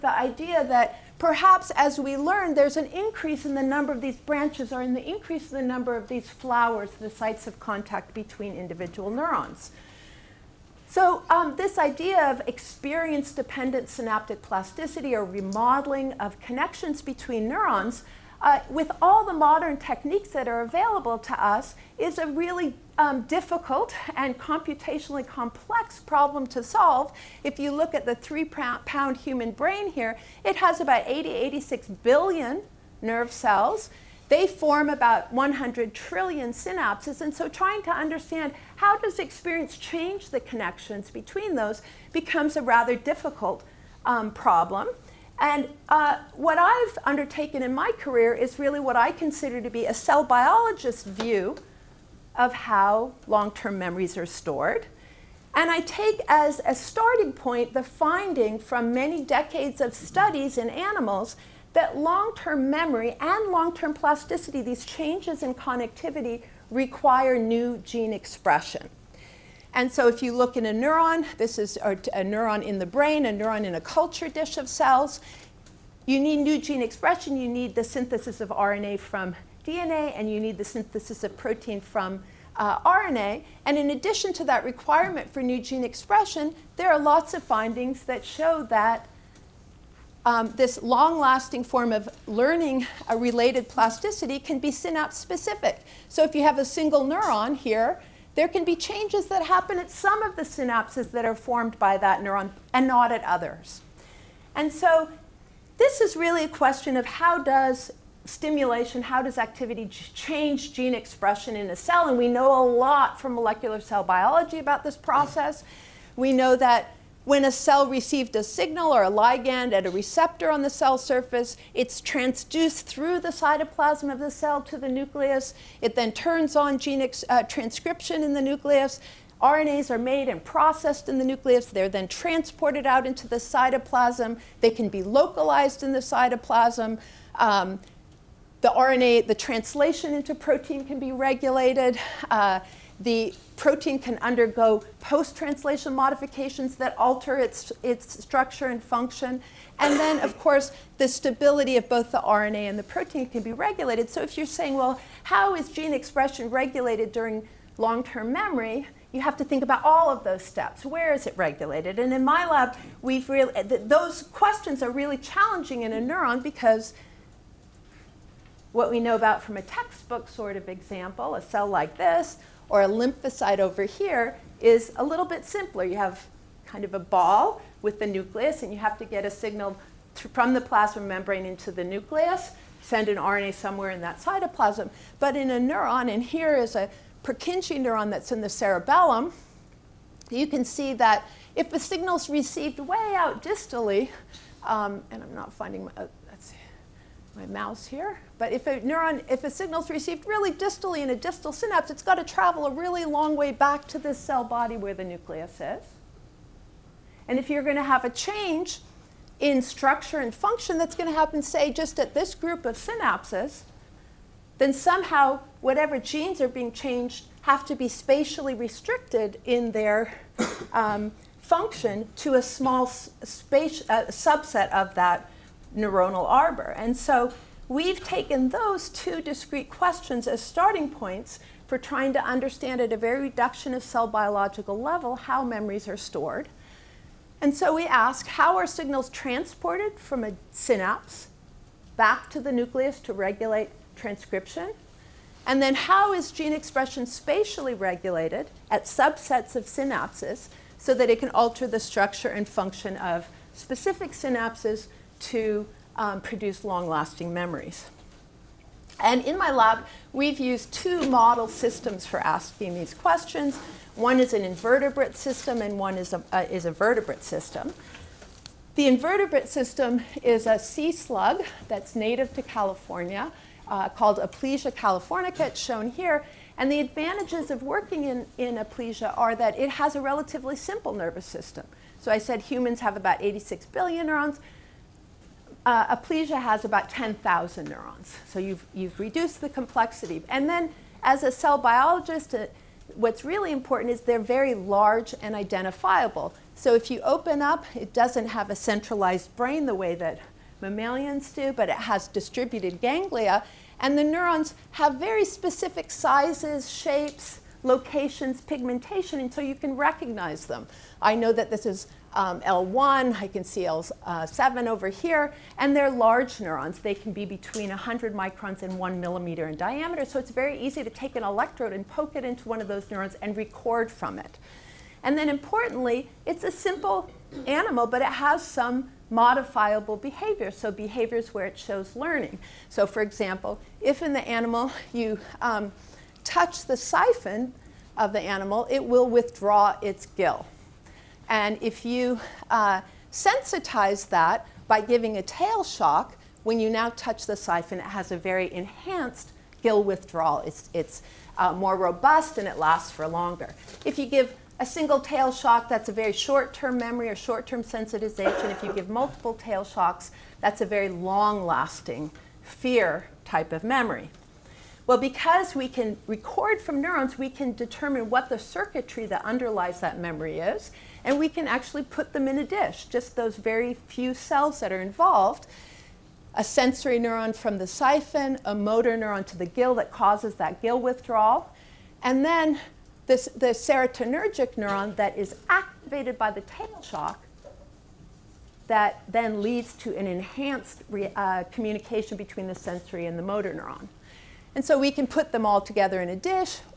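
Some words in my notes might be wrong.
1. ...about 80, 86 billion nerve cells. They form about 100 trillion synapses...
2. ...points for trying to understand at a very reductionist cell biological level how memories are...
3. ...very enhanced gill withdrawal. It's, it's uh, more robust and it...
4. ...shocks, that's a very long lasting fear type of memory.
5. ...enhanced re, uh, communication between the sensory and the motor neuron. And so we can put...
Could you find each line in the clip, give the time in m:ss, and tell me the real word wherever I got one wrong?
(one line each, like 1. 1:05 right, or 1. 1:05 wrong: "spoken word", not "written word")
1. 0:30 right
2. 3:50 right
3. 5:48 right
4. 5:59 right
5. 6:30 right.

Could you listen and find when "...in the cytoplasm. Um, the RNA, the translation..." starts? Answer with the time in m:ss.
2:15.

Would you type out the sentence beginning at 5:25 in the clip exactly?
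And then importantly, it's a simple animal, but it has some modifiable behavior, so behaviors where it shows learning.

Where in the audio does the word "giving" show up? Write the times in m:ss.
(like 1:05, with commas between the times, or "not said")
5:44.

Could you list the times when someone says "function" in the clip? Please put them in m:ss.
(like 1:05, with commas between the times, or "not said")
2:28, 3:30, 3:41, 4:12.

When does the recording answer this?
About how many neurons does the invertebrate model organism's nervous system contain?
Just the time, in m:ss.
4:46.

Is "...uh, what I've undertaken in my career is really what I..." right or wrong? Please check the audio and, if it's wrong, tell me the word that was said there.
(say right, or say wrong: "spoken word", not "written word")
right.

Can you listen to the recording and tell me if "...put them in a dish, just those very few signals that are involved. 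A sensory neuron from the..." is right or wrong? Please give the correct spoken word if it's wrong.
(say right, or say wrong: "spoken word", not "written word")
wrong: "cells", not "signals".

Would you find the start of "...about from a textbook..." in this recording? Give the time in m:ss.
2:49.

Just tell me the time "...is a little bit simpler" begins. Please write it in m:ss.
2:54.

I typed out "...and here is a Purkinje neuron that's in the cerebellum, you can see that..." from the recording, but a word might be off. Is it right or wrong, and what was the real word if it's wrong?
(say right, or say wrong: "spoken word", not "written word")
right.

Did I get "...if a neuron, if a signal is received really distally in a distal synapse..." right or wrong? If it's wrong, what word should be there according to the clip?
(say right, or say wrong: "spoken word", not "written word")
right.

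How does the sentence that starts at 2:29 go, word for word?
And then, of course, the stability of both the RNA and the protein can be regulated.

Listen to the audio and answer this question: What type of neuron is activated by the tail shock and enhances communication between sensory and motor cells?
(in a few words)
serotonergic neuron.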